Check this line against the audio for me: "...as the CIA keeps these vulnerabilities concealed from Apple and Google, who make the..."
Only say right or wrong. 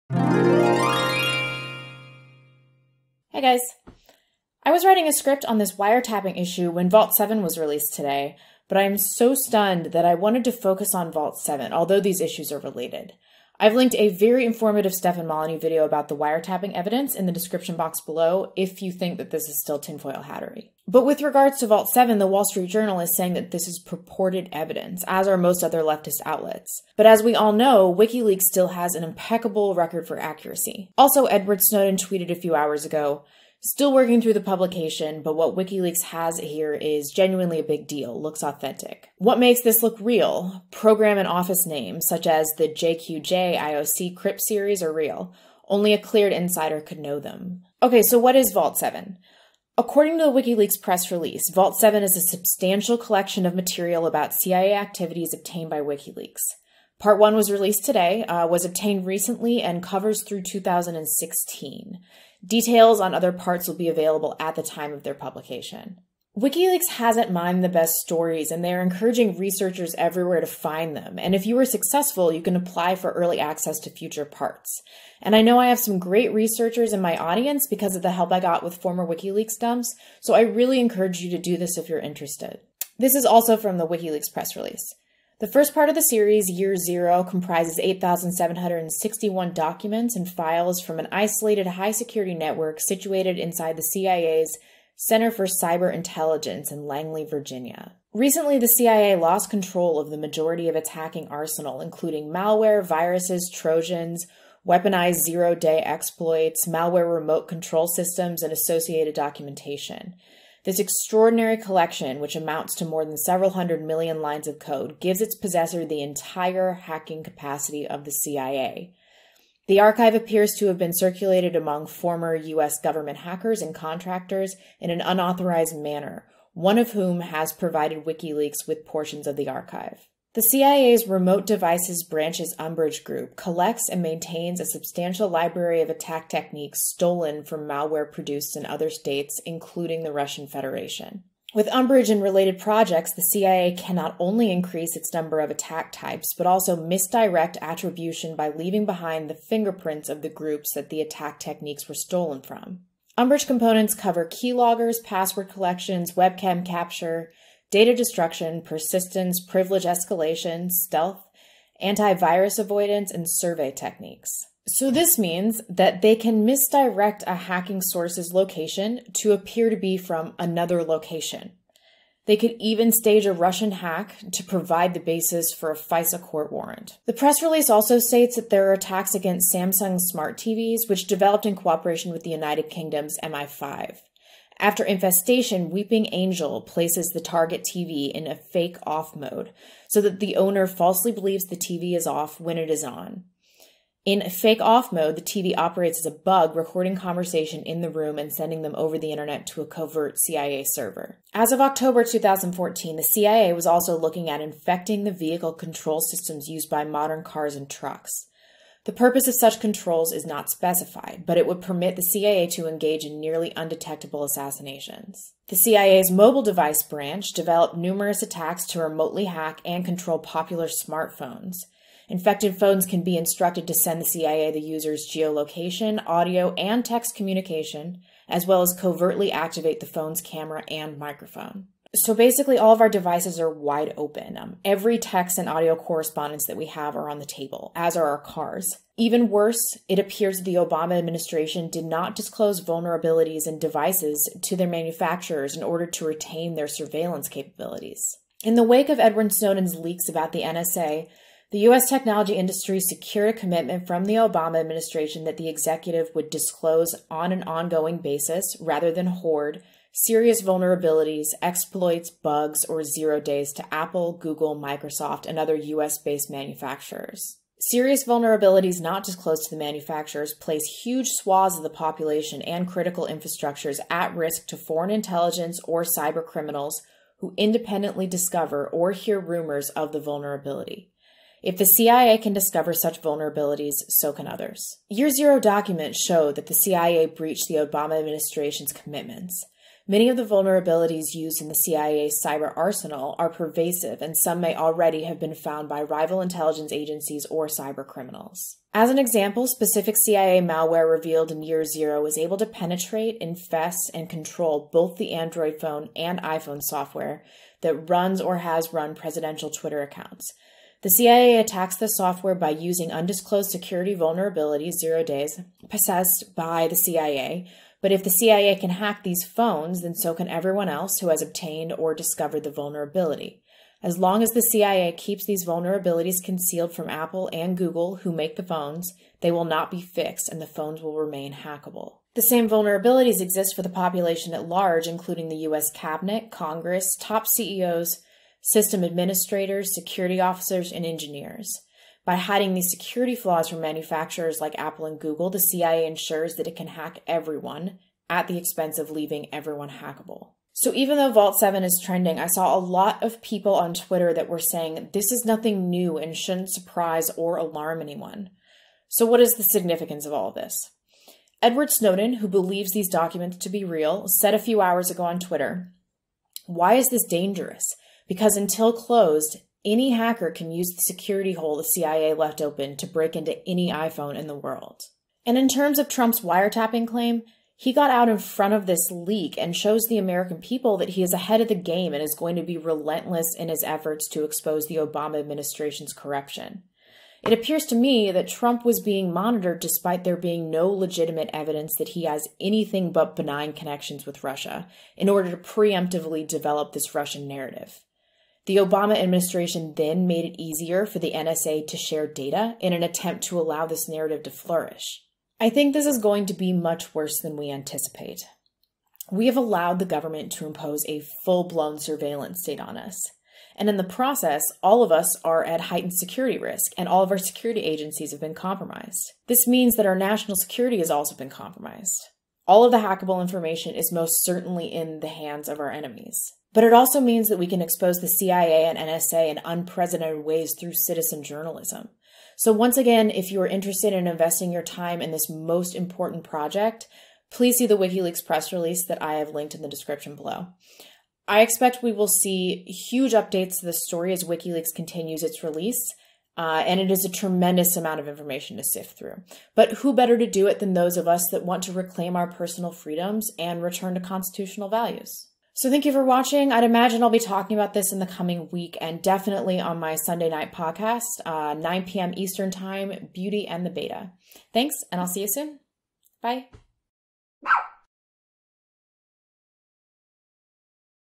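right.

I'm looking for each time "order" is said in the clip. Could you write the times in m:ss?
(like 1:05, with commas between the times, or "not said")
4:05, 6:35.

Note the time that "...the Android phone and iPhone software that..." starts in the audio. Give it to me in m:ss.
5:04.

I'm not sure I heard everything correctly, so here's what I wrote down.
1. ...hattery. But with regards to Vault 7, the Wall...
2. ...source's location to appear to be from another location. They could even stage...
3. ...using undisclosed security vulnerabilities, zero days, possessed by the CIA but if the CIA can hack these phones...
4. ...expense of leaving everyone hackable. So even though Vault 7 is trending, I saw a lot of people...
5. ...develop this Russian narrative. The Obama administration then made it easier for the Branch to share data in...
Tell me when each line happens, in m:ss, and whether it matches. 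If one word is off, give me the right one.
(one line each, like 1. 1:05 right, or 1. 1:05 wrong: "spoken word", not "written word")
1. 0:20 right
2. 2:47 right
3. 5:12 right
4. 5:48 right
5. 6:36 wrong: "NSA", not "Branch".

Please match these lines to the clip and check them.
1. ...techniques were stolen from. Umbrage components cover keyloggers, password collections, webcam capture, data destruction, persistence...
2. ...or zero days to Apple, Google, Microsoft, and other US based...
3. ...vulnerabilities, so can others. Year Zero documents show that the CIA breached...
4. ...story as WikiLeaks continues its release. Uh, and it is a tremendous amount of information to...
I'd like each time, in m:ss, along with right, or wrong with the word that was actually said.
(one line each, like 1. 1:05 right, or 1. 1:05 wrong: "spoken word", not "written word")
1. 2:31 right
2. 4:22 right
3. 4:43 right
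4. 7:23 right.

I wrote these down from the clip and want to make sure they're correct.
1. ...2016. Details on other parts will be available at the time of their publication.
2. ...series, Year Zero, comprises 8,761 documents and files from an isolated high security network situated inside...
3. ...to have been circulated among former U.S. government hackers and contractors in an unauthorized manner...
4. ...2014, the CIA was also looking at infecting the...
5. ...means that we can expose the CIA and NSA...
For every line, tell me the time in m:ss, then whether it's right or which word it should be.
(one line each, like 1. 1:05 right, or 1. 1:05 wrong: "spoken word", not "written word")
1. 1:00 right
2. 1:26 right
3. 2:00 right
4. 3:22 right
5. 7:06 right.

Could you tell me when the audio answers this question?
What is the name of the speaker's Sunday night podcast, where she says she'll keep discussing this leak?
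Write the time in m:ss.
7:43.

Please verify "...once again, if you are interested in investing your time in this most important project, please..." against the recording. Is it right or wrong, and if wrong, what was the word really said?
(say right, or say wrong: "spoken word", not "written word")
right.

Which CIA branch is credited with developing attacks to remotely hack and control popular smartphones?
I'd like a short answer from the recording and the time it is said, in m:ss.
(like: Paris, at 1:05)
Mobile device branch, at 3:36.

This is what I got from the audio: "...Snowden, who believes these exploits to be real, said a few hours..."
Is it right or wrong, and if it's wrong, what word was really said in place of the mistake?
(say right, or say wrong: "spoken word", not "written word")
wrong: "documents", not "exploits".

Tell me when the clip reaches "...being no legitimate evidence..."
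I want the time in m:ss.
6:30.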